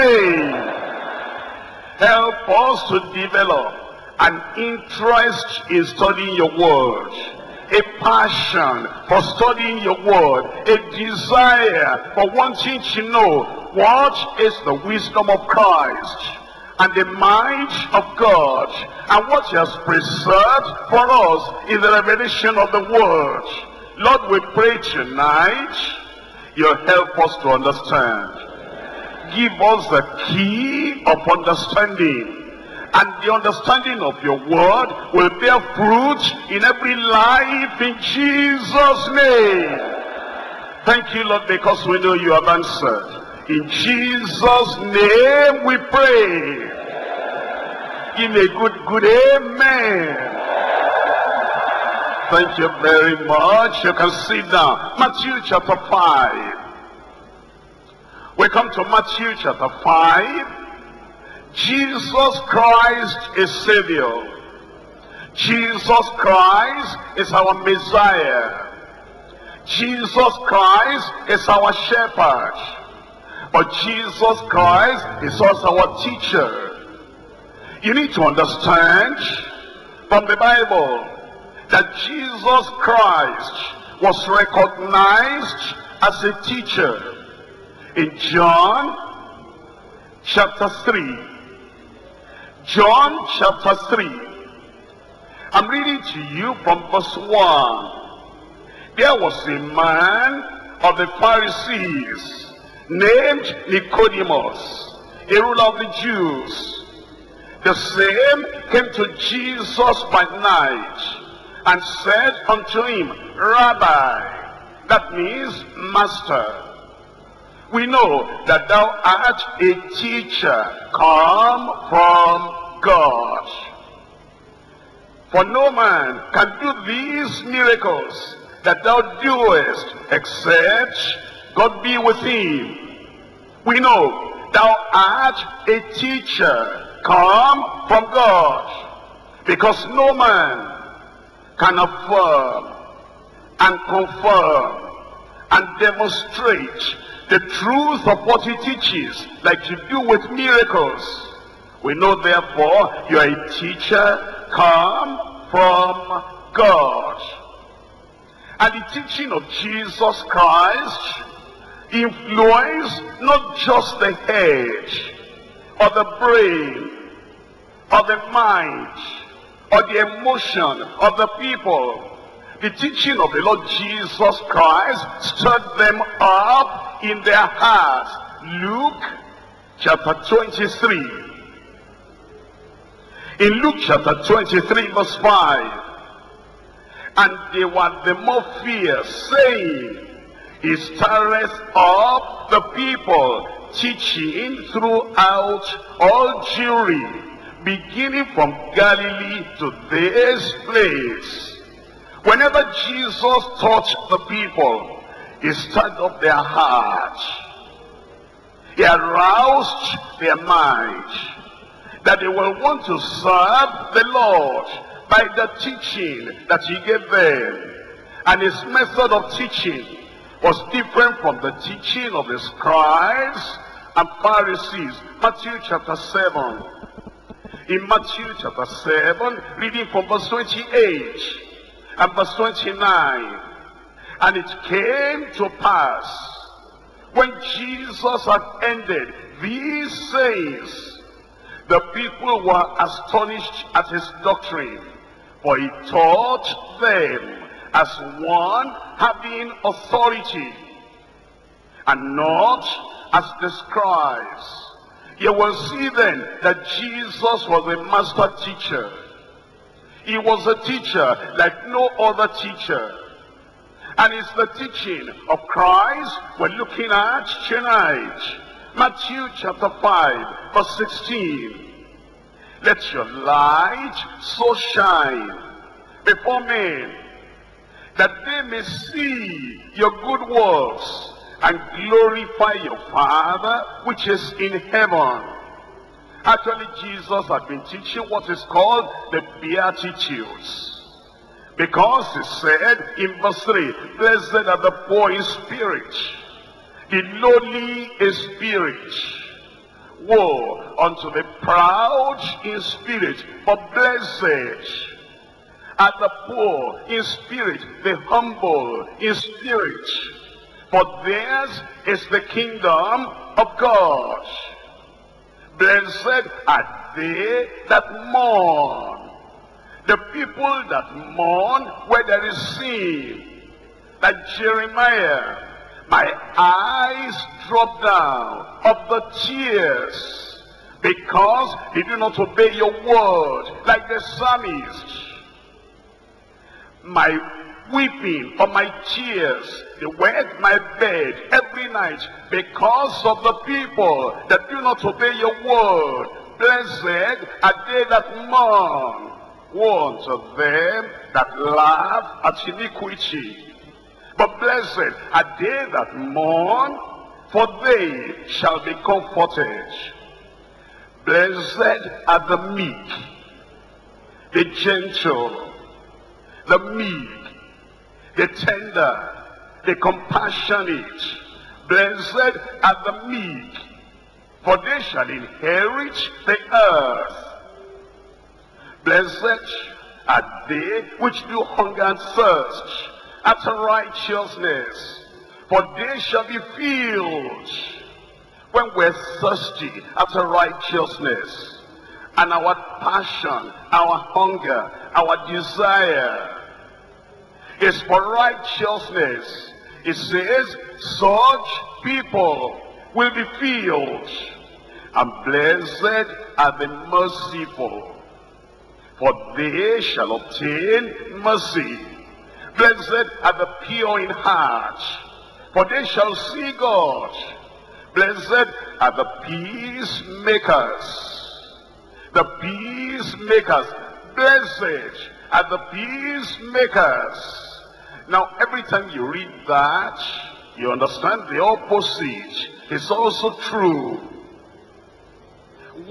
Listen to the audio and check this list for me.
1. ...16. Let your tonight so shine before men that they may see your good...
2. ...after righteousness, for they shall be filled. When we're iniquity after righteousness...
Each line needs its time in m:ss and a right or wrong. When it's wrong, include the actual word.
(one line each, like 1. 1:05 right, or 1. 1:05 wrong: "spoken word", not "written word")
1. 4:30 wrong: "light", not "tonight"
2. 6:23 wrong: "thirsty", not "iniquity".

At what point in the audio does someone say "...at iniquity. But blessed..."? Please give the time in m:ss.
5:52.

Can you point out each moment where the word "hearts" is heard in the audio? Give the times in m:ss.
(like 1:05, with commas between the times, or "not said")
2:57, 3:26, 6:54.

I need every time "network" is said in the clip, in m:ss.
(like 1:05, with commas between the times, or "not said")
not said.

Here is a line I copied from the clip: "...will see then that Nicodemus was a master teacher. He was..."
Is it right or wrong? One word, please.
wrong.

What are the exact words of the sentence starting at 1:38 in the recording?
There was a man of the Pharisees named Nicodemus, a ruler of the Jews.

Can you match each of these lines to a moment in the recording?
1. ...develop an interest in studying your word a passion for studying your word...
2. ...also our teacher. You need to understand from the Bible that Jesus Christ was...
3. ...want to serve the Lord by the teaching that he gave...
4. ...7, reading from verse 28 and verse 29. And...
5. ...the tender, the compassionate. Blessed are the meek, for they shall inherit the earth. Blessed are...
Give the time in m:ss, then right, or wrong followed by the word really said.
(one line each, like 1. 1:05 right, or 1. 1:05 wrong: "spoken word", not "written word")
1. 0:03 right
2. 1:15 right
3. 3:32 right
4. 3:48 right
5. 6:08 right.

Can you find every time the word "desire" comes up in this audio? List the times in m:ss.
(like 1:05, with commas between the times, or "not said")
0:10, 6:35.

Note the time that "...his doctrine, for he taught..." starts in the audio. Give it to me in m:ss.
4:03.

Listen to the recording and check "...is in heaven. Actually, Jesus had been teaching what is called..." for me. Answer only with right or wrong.
right.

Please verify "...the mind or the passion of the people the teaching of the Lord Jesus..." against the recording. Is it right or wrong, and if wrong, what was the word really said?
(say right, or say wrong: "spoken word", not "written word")
wrong: "emotion", not "passion".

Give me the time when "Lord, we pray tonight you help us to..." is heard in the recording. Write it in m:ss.
0:23.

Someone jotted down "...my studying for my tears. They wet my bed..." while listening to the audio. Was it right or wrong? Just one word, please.
wrong.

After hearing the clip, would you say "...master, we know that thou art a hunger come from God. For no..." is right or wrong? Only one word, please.
wrong.